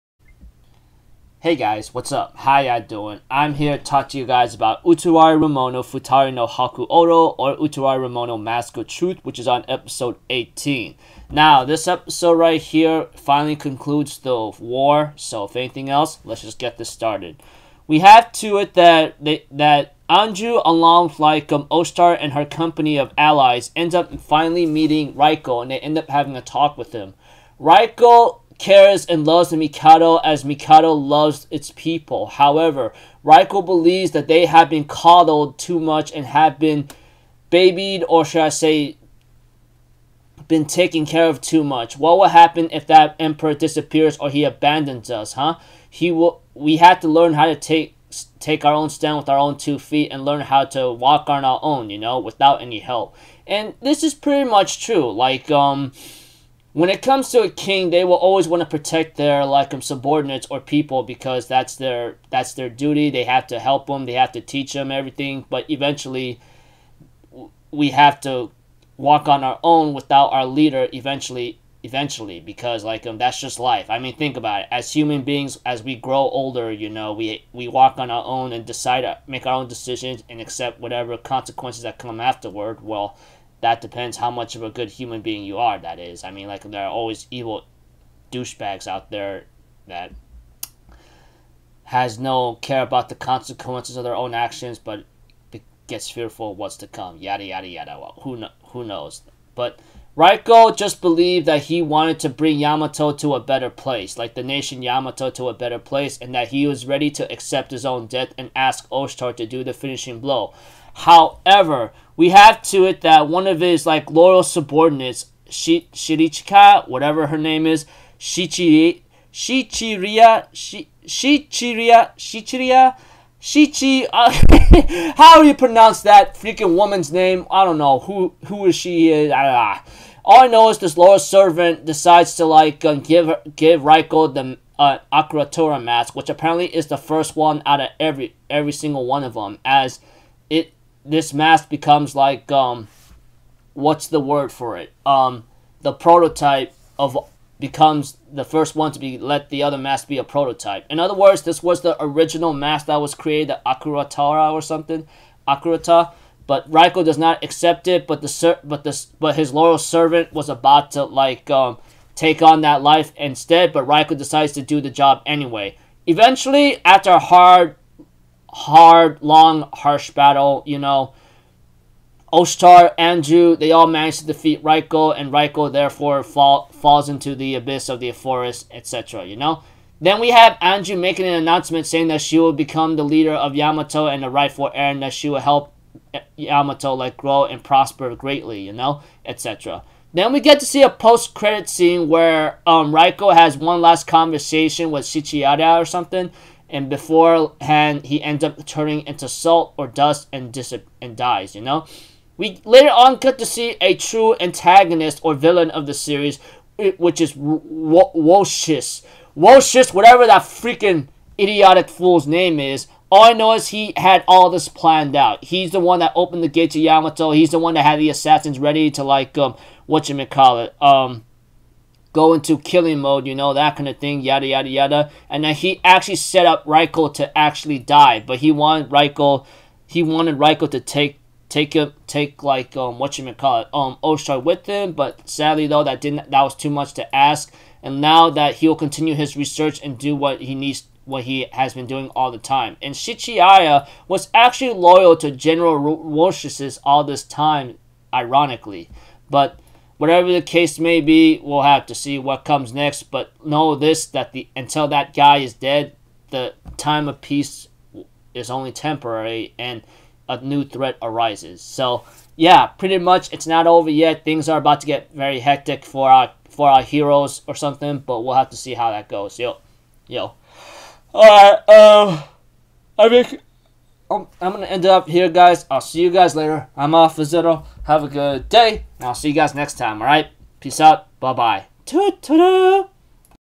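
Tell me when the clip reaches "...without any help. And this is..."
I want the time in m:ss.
0:52.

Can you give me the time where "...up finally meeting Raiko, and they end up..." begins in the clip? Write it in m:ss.
0:23.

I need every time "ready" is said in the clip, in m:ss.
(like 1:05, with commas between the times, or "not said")
1:46, 3:38.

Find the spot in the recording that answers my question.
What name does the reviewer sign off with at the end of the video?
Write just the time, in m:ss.
4:36.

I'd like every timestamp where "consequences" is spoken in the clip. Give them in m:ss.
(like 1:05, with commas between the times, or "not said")
1:21, 1:33.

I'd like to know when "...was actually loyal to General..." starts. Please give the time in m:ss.
4:04.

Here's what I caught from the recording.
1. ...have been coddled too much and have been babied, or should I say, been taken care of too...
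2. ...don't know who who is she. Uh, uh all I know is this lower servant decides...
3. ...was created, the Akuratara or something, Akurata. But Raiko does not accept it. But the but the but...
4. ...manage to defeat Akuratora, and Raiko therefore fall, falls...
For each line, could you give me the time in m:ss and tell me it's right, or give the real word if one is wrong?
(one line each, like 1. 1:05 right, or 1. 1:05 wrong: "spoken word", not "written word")
1. 0:34 right
2. 2:07 right
3. 2:32 right
4. 2:53 wrong: "Raiko", not "Akuratora".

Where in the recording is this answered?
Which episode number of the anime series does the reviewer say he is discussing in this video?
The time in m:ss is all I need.
0:09.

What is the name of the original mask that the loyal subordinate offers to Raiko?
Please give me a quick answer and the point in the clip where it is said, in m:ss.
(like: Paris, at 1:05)
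Akuratora, at 2:15.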